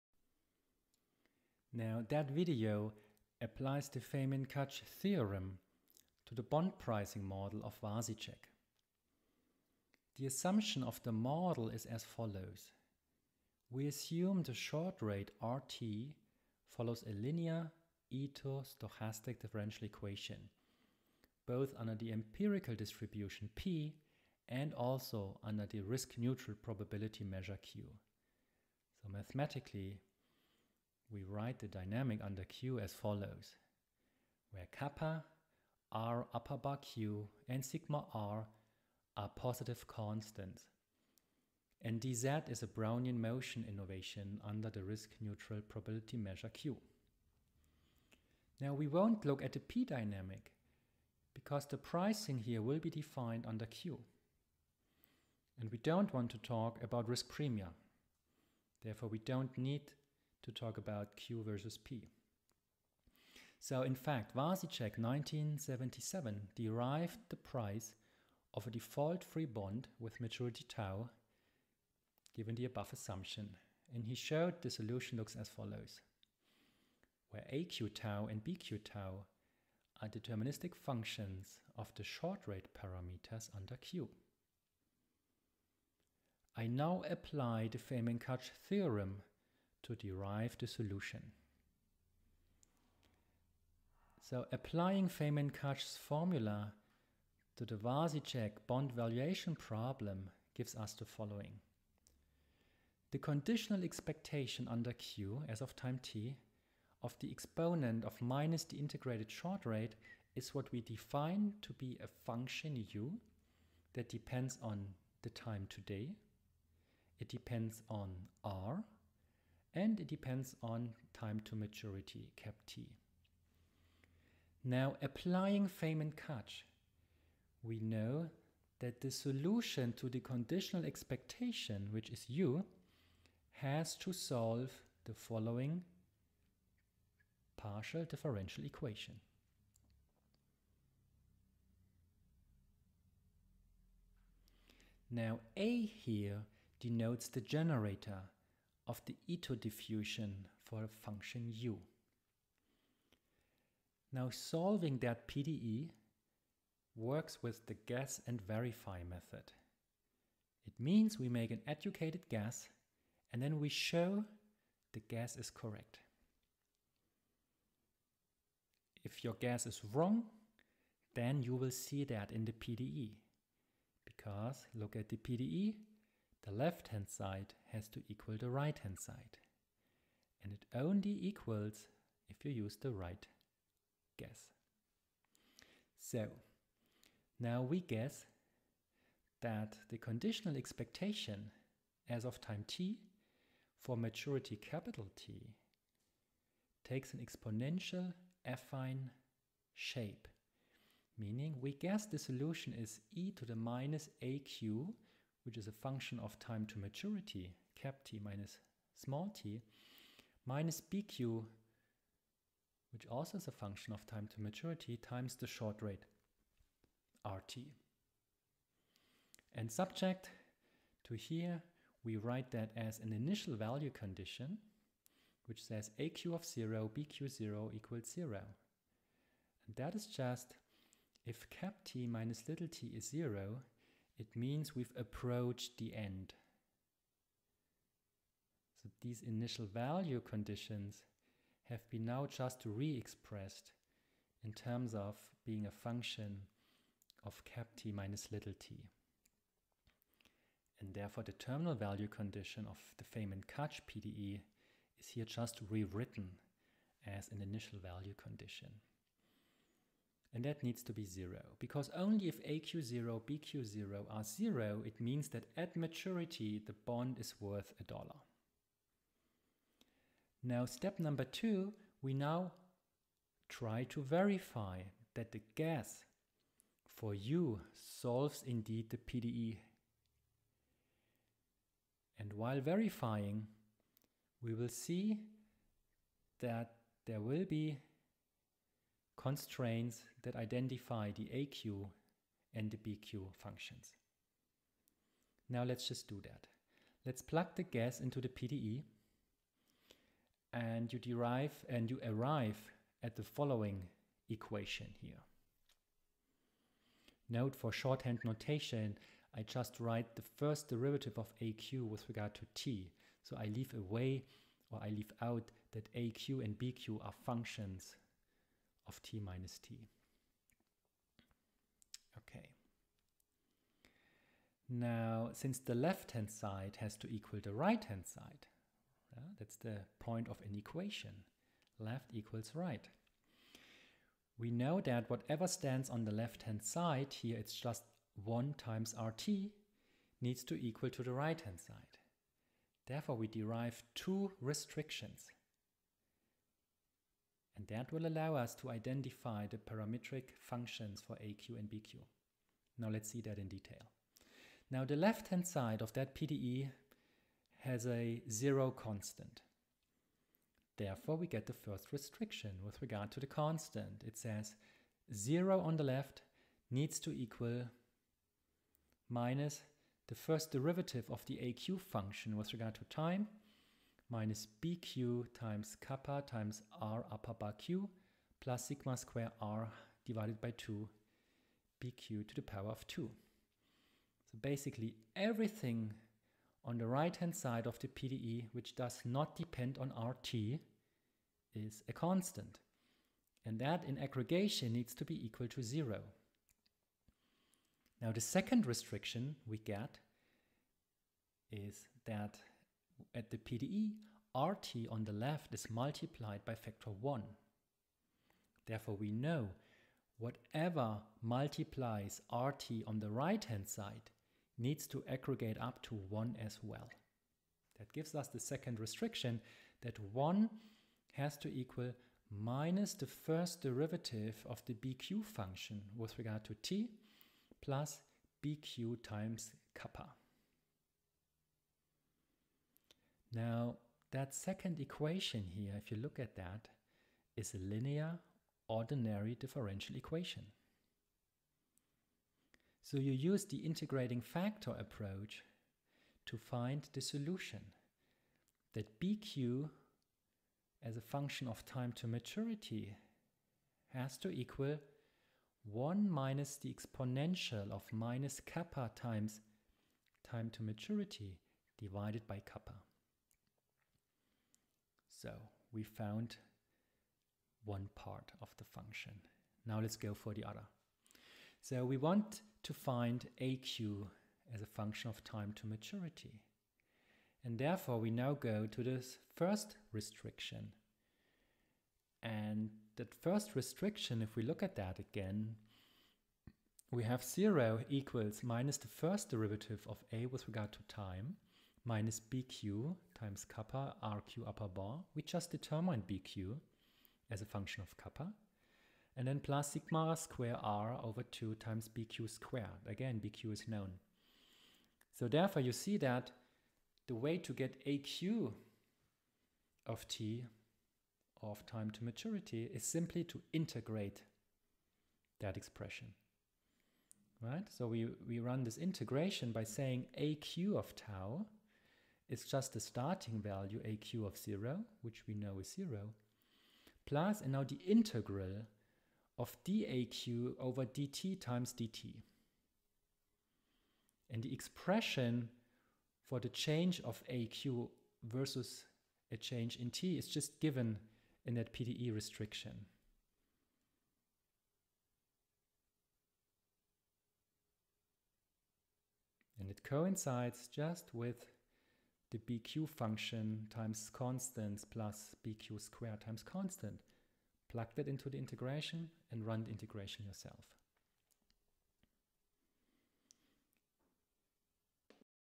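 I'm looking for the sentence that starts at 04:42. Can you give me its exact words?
And while verifying, we will see that there will be constraints that identify the AQ and the BQ functions.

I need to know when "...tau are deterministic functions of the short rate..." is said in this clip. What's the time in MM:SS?
01:18.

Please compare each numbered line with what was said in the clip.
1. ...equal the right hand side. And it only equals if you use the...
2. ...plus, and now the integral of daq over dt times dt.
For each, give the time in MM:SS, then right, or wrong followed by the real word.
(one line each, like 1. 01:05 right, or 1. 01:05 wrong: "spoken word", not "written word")
1. 02:58 right
2. 08:47 right.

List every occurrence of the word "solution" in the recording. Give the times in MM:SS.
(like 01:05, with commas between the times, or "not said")
01:14, 01:30, 02:09, 03:22, 07:27.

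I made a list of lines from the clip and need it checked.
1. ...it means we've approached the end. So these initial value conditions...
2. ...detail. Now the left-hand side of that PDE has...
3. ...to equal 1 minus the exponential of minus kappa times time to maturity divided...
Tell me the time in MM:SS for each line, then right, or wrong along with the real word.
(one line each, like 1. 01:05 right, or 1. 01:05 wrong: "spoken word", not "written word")
1. 03:54 right
2. 05:53 right
3. 07:34 right.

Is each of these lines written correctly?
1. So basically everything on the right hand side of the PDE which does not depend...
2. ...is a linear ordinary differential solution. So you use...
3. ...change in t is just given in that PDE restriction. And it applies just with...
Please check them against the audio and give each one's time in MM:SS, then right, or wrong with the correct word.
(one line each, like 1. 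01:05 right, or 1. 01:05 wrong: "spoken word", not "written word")
1. 06:24 right
2. 07:17 wrong: "equation", not "solution"
3. 08:59 wrong: "coincides", not "applies".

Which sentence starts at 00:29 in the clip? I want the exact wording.
So mathematically, we write the dynamic under Q as follows, where kappa, r upper bar Q, and sigma r are positive constants.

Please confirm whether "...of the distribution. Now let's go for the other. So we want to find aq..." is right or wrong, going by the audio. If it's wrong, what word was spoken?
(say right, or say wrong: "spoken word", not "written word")
wrong: "function", not "distribution".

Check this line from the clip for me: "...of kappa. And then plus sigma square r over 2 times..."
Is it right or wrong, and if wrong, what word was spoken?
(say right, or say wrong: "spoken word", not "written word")
right.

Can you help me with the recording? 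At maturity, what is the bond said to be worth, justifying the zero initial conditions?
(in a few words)
a dollar.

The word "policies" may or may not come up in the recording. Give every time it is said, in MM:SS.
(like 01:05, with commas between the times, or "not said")
not said.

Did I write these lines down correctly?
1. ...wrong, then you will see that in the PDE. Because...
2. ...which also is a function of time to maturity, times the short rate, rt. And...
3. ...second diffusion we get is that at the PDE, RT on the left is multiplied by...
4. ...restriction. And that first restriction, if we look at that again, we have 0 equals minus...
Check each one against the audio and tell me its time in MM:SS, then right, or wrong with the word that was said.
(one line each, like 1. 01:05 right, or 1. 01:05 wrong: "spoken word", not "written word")
1. 02:49 right
2. 03:32 right
3. 06:38 wrong: "restriction", not "diffusion"
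4. 07:59 right.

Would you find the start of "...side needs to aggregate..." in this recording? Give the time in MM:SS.
06:53.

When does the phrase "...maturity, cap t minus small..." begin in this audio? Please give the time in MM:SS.
03:26.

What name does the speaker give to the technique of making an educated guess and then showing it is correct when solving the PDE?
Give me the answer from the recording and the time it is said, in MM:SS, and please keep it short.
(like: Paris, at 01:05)
guess and verify, at 02:37.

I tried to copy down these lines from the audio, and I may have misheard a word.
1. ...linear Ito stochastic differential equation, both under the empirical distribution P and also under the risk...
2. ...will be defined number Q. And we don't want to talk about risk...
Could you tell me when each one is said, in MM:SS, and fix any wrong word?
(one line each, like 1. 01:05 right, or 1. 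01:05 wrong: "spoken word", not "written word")
1. 00:17 right
2. 00:52 wrong: "under", not "number".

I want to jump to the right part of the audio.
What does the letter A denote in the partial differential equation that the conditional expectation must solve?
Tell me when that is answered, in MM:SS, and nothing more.
02:27.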